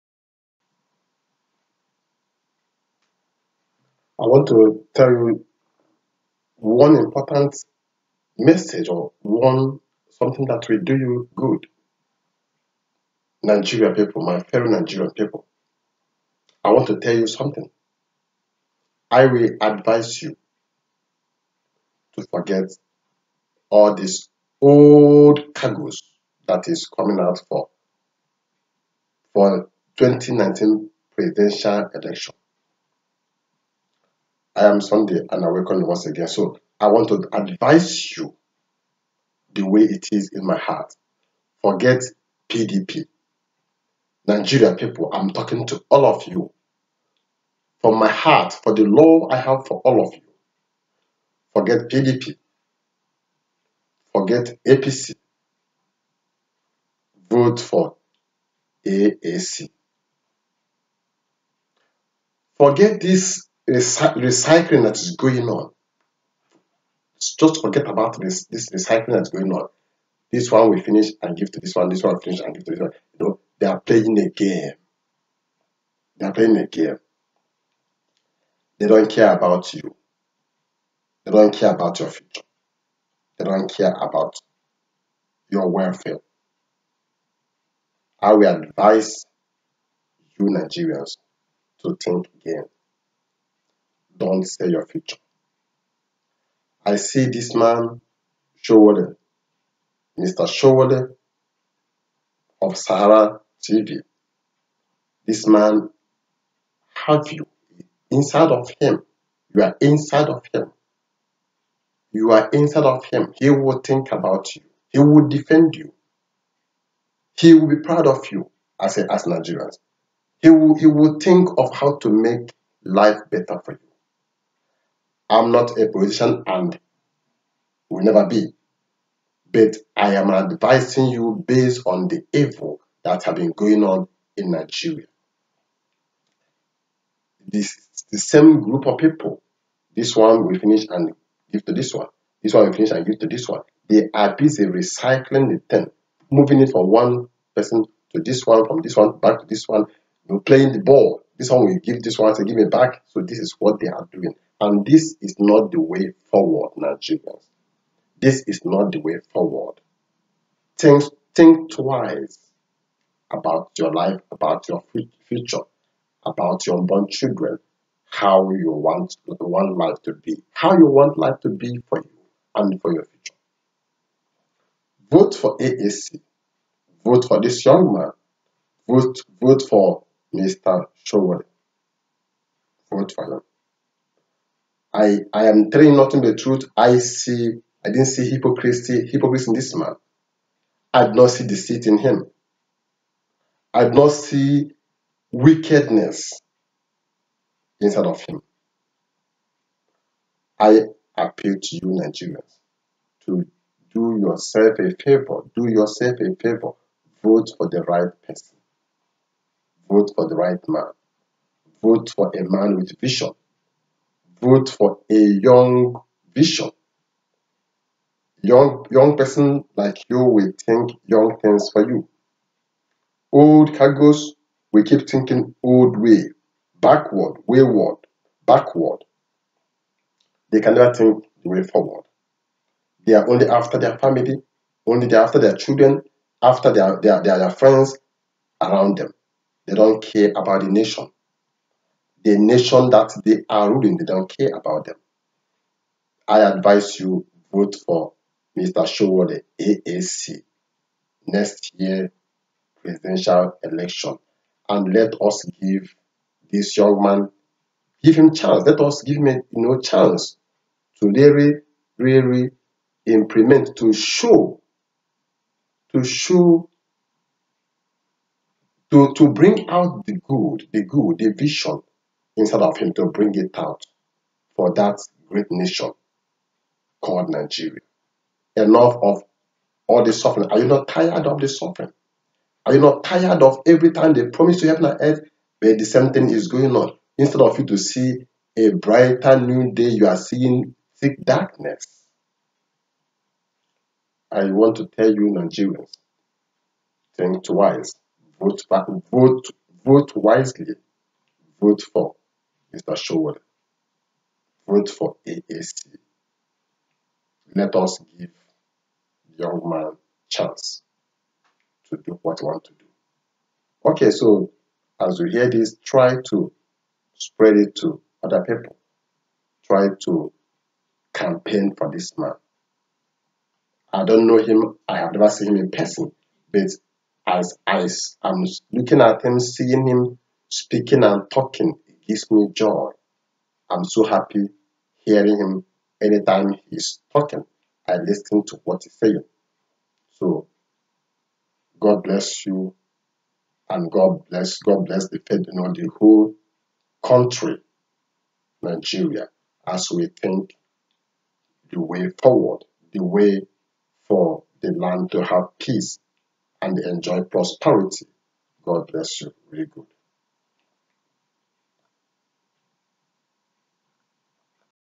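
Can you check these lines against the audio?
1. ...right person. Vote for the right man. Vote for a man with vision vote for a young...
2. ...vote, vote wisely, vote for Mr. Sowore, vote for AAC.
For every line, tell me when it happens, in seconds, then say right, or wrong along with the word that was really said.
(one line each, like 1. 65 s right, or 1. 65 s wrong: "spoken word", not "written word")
1. 207 s right
2. 299 s right.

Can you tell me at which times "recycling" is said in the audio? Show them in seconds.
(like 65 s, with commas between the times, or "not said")
63 s, 68 s, 144 s.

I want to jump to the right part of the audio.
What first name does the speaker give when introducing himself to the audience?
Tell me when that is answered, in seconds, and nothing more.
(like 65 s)
34 s.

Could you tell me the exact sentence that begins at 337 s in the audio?
I listen to what he's saying.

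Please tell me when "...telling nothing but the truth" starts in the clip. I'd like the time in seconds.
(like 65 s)
185 s.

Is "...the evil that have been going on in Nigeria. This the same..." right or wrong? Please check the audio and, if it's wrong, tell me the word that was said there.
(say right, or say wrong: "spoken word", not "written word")
right.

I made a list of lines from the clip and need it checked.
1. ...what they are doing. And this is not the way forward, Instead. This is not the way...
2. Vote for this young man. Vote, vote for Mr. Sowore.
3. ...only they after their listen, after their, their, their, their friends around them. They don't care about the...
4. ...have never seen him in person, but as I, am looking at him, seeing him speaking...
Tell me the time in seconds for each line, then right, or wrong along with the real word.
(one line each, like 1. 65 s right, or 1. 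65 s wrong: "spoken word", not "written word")
1. 153 s wrong: "Nigerians", not "Instead"
2. 177 s right
3. 234 s wrong: "children", not "listen"
4. 324 s right.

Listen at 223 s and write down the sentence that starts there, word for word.
Old cargoes will keep thinking old way, backward, wayward, backward.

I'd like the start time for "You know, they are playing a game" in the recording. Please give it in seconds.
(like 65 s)
73 s.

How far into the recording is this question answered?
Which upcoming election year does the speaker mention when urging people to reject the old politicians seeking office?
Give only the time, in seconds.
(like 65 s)
29 s.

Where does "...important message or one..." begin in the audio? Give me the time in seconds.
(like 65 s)
6 s.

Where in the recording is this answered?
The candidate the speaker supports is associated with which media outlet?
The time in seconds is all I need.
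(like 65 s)
102 s.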